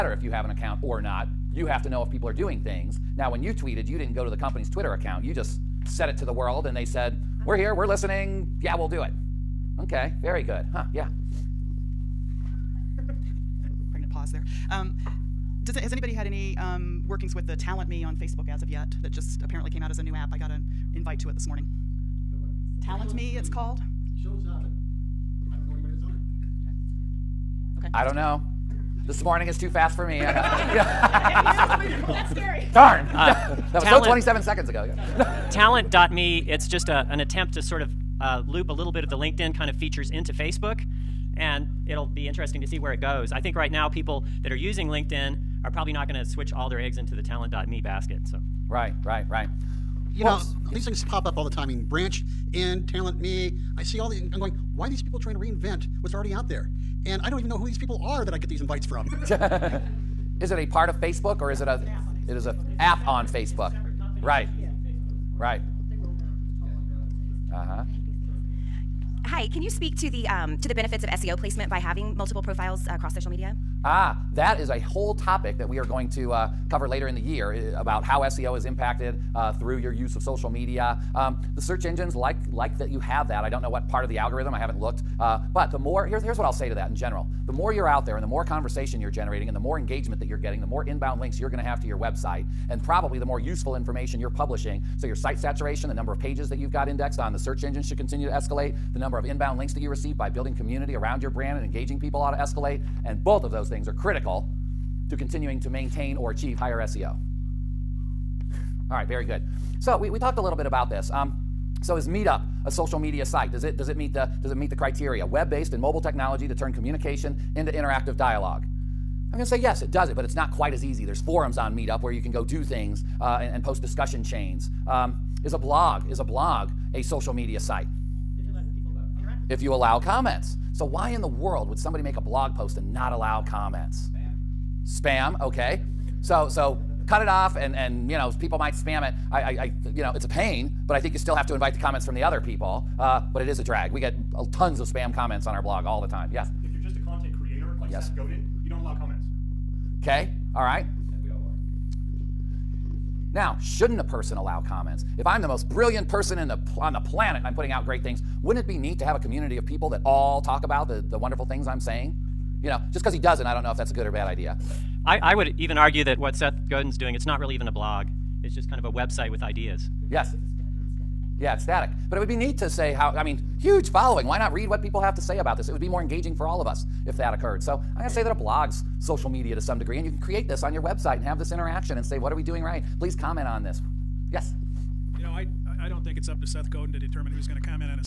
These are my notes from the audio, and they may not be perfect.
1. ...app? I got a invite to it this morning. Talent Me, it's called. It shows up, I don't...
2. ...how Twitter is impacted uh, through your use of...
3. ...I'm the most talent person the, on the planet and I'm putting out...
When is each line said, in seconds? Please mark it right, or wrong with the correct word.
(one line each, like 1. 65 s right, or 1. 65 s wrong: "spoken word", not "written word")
1. 20 s right
2. 78 s wrong: "SEO", not "Twitter"
3. 155 s wrong: "brilliant", not "talent".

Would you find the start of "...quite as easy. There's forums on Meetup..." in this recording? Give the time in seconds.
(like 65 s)
120 s.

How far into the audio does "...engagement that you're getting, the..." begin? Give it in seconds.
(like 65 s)
89 s.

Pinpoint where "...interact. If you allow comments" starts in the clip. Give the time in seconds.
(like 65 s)
129 s.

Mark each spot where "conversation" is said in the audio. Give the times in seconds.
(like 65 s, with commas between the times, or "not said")
88 s.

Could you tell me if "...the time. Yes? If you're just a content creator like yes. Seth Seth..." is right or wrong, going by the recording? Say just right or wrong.
wrong.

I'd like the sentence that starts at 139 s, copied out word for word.
I, I, I you know it's a pain but I think you still have to invite the comments from the other people.